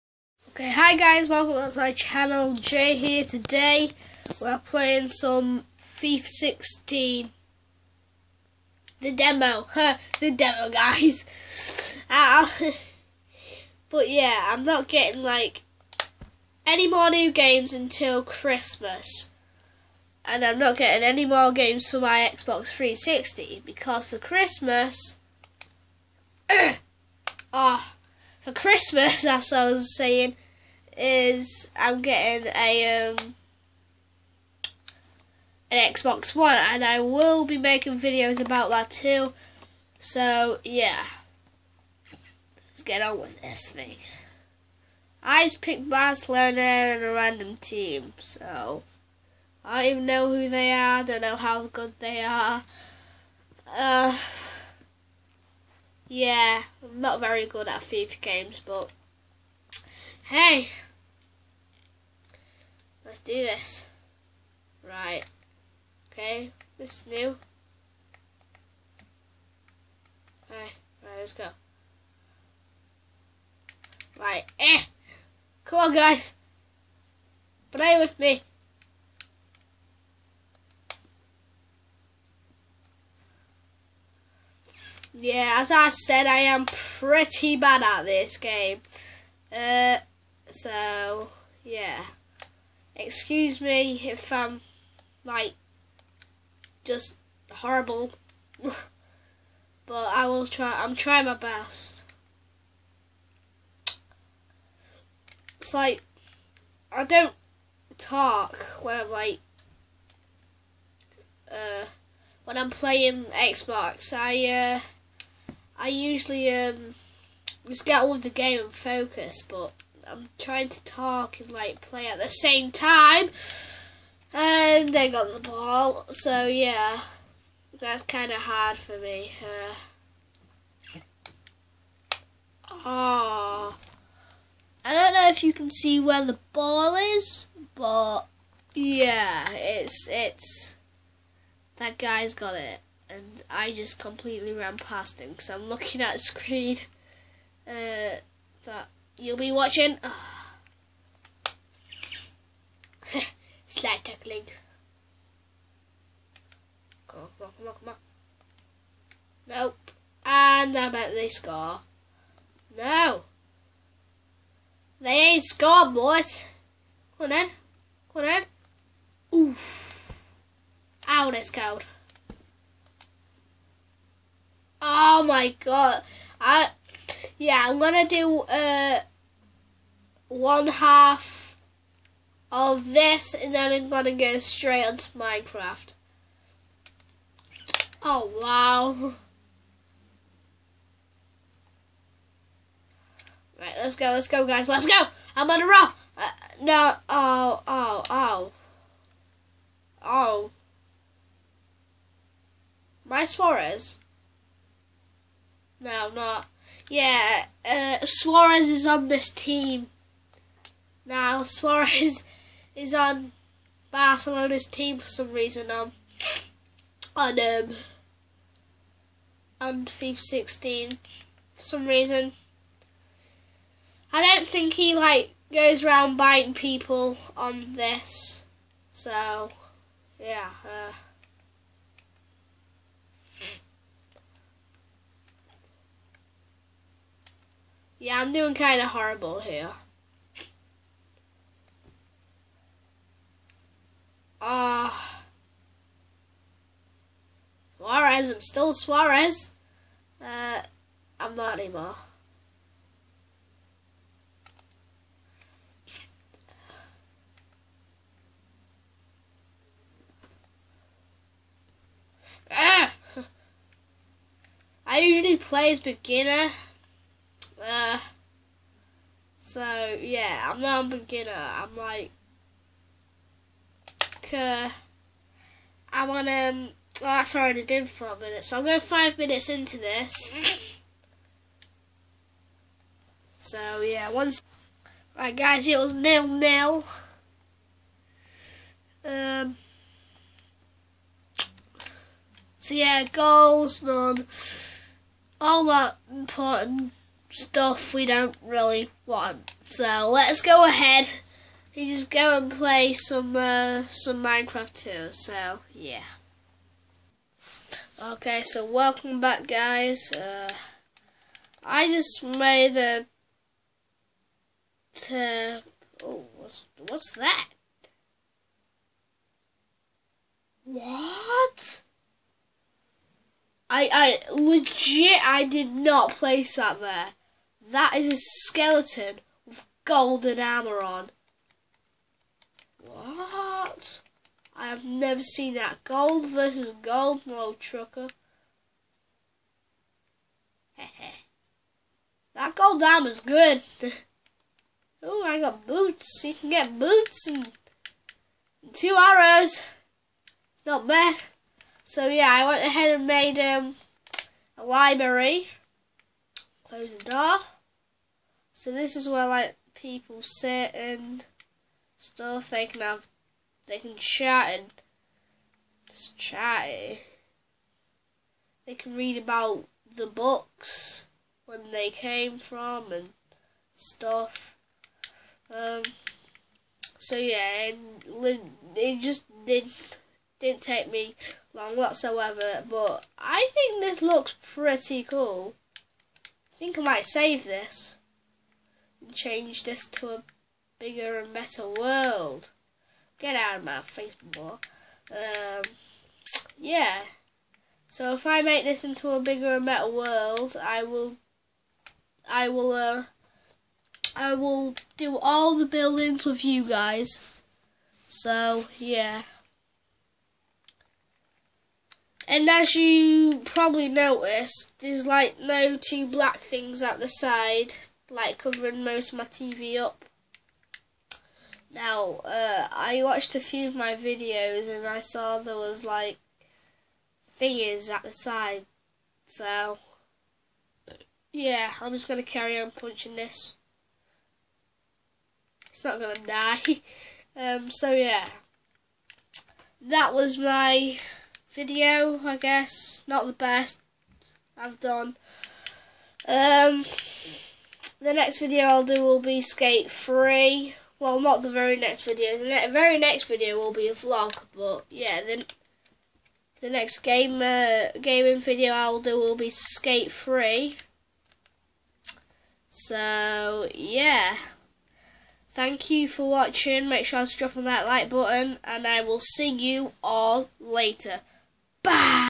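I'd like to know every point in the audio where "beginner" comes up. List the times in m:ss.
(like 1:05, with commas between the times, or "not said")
4:25, 4:30.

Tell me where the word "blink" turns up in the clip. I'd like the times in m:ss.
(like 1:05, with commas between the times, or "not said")
not said.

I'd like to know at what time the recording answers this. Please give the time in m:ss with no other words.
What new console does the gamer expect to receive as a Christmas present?
0:35.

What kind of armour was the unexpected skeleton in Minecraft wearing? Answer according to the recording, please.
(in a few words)
Golden armour.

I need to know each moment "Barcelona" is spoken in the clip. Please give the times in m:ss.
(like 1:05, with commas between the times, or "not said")
0:45, 3:33.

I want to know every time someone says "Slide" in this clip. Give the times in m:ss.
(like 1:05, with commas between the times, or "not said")
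2:33.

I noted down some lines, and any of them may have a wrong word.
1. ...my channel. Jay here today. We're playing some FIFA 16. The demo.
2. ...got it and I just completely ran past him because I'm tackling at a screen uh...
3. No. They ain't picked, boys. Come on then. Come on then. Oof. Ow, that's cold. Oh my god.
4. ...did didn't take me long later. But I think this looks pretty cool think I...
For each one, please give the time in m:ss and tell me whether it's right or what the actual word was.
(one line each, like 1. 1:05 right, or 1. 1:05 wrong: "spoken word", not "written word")
1. 0:01 right
2. 2:22 wrong: "looking", not "tackling"
3. 2:42 wrong: "scored", not "picked"
4. 6:19 wrong: "whatsoever", not "later".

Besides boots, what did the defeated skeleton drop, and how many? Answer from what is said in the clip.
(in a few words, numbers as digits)
2 arrows.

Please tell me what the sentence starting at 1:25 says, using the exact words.
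yeah, as I said, I am pretty bad at this game.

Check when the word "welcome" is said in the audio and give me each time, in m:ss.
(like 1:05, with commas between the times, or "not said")
0:01, 5:08.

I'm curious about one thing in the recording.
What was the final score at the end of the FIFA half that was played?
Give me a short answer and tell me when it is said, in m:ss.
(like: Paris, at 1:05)
0-0, at 4:45.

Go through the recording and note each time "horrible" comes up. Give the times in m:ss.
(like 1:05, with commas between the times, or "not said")
1:37, 3:58.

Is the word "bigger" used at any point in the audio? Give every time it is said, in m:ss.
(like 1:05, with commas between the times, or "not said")
6:30, 6:39.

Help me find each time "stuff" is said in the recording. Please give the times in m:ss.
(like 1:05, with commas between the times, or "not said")
4:57, 6:01, 6:13.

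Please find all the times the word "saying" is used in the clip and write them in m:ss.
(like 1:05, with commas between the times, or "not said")
0:29.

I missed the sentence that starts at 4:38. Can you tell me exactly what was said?
So I'm going five minutes into this.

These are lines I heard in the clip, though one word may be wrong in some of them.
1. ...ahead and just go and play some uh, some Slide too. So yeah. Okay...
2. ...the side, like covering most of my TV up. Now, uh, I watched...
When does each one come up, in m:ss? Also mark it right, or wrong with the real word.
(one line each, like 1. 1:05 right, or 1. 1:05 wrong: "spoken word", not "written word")
1. 5:00 wrong: "Minecraft", not "Slide"
2. 6:57 right.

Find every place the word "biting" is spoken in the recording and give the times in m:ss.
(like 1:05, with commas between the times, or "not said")
3:46.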